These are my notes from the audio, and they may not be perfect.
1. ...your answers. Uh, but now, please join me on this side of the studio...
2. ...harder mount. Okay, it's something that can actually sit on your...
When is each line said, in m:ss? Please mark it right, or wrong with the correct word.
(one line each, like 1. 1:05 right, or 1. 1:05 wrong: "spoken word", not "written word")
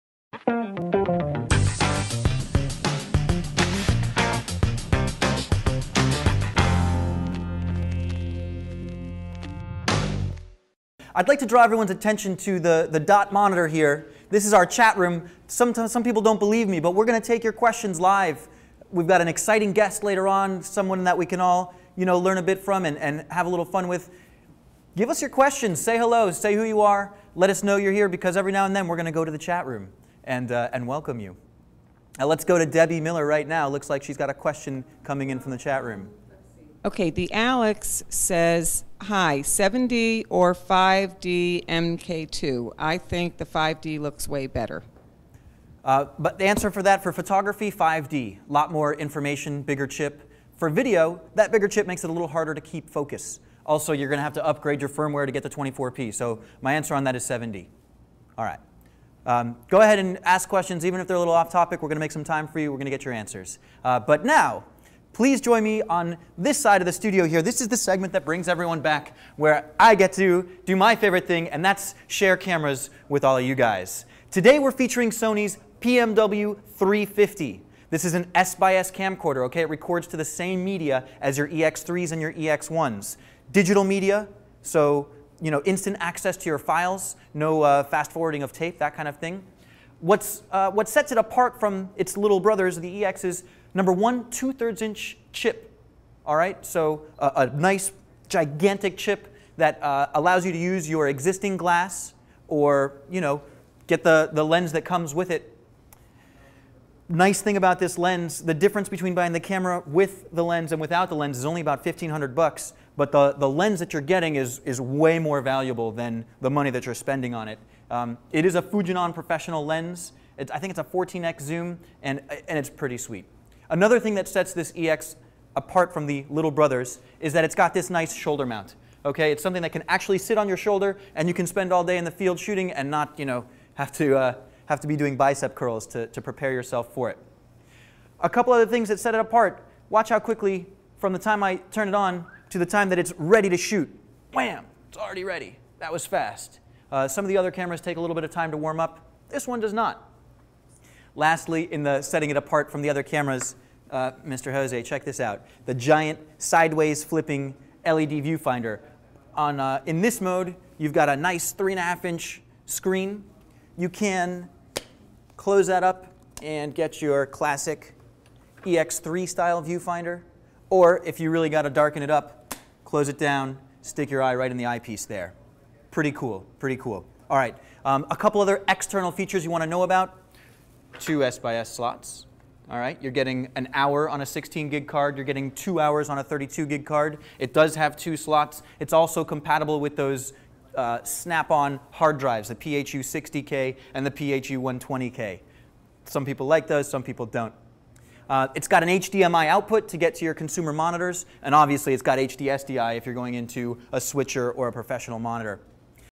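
1. 1:03 right
2. 2:08 wrong: "shoulder", not "harder".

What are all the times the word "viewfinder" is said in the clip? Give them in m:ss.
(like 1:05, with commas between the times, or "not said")
2:38, 2:49.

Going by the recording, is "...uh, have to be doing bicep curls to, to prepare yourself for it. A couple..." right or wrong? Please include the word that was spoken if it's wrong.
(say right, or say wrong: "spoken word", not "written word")
right.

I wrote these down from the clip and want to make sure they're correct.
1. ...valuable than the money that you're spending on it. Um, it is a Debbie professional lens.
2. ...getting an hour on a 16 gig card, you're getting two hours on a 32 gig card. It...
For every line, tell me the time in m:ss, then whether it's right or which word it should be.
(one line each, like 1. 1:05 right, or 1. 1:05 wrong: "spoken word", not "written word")
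1. 1:55 wrong: "Fujinon", not "Debbie"
2. 3:03 right.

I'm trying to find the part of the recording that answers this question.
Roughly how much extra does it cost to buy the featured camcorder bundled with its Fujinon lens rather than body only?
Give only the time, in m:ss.
1:51.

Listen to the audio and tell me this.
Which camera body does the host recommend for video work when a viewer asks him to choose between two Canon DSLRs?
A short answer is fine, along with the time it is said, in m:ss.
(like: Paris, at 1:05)
7D, at 0:56.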